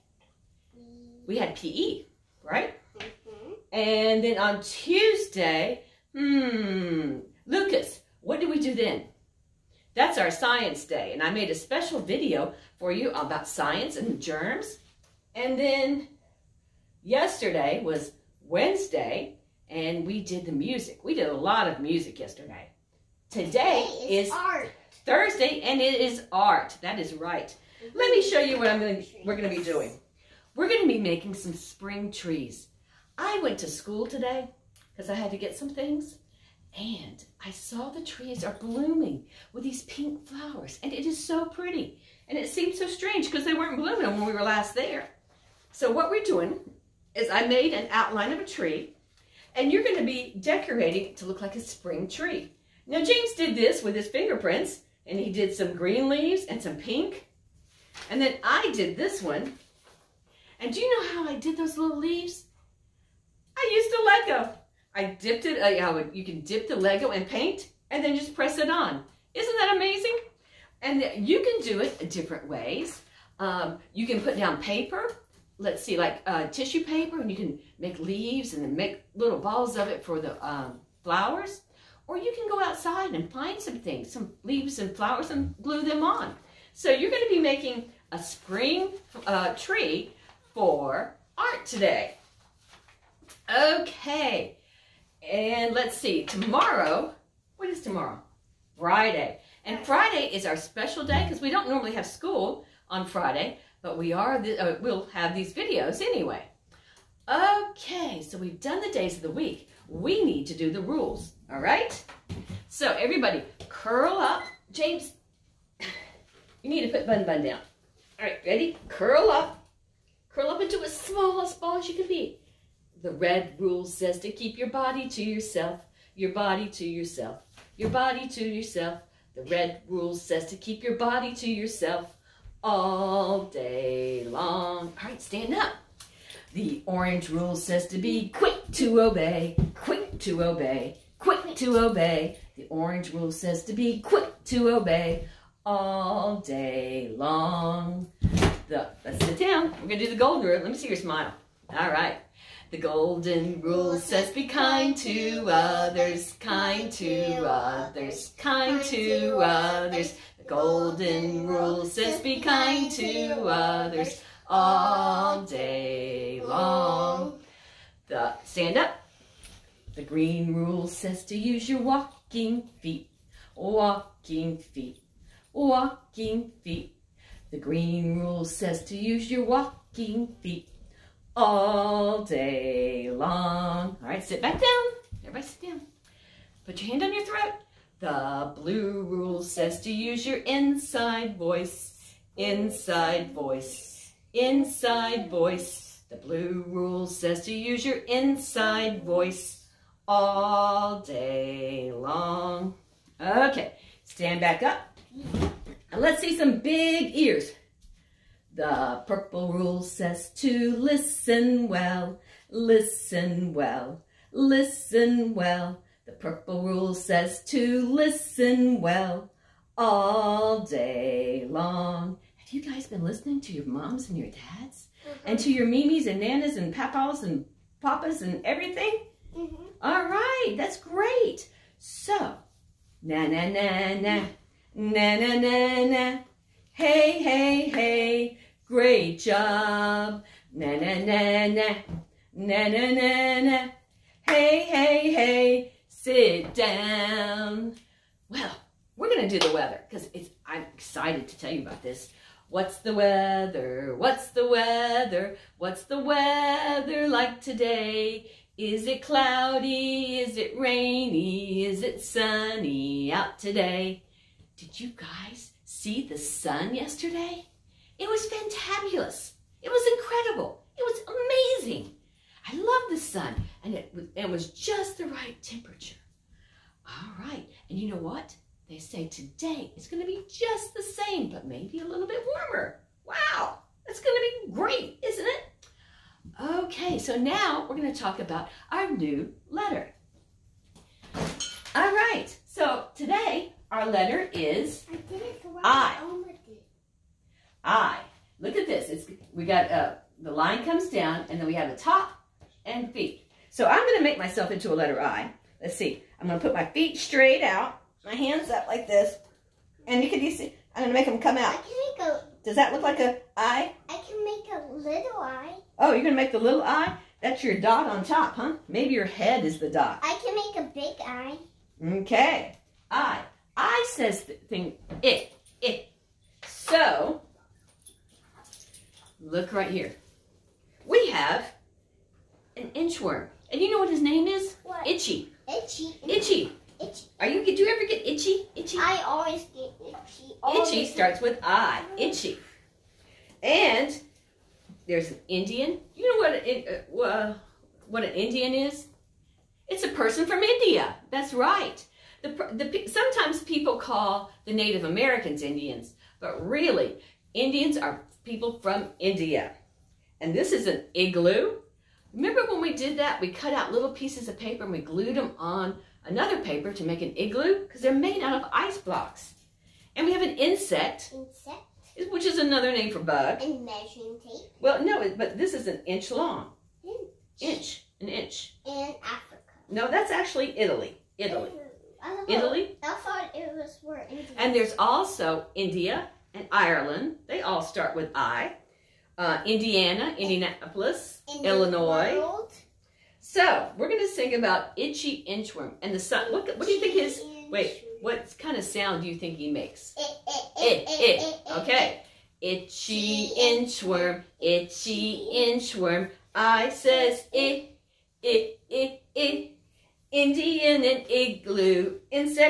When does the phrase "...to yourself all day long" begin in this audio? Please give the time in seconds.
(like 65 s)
131 s.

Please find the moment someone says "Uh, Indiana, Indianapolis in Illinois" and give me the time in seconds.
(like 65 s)
389 s.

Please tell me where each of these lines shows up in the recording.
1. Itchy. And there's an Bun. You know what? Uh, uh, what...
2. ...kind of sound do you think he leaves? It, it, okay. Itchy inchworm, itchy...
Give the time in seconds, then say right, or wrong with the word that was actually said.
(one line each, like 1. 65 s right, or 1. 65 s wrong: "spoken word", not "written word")
1. 341 s wrong: "Indian", not "Bun"
2. 398 s wrong: "makes", not "leaves".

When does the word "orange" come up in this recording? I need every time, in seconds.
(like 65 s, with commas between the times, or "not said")
136 s, 142 s.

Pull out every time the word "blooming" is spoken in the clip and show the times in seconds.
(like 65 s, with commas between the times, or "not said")
38 s, 43 s.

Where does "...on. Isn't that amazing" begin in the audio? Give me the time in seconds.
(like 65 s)
68 s.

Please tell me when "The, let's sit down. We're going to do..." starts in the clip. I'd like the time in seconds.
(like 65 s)
148 s.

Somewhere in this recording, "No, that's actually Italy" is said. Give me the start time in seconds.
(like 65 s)
379 s.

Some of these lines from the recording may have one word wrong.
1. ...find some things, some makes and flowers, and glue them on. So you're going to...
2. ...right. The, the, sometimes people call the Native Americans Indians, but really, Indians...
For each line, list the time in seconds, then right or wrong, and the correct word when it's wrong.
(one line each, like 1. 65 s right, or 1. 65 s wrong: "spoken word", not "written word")
1. 83 s wrong: "leaves", not "makes"
2. 351 s right.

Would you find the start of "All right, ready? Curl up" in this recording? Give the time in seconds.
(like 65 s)
118 s.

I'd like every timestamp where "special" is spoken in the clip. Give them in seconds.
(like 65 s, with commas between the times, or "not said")
11 s, 100 s.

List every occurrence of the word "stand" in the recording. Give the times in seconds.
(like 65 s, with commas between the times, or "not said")
135 s, 168 s, 204 s.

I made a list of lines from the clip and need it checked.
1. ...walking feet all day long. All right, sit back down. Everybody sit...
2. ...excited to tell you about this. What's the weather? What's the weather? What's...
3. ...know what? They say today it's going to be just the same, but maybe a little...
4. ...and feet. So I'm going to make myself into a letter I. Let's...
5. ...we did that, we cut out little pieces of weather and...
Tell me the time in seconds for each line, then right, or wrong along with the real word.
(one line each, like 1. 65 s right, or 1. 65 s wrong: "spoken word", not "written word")
1. 179 s right
2. 250 s right
3. 277 s right
4. 302 s right
5. 362 s wrong: "paper", not "weather".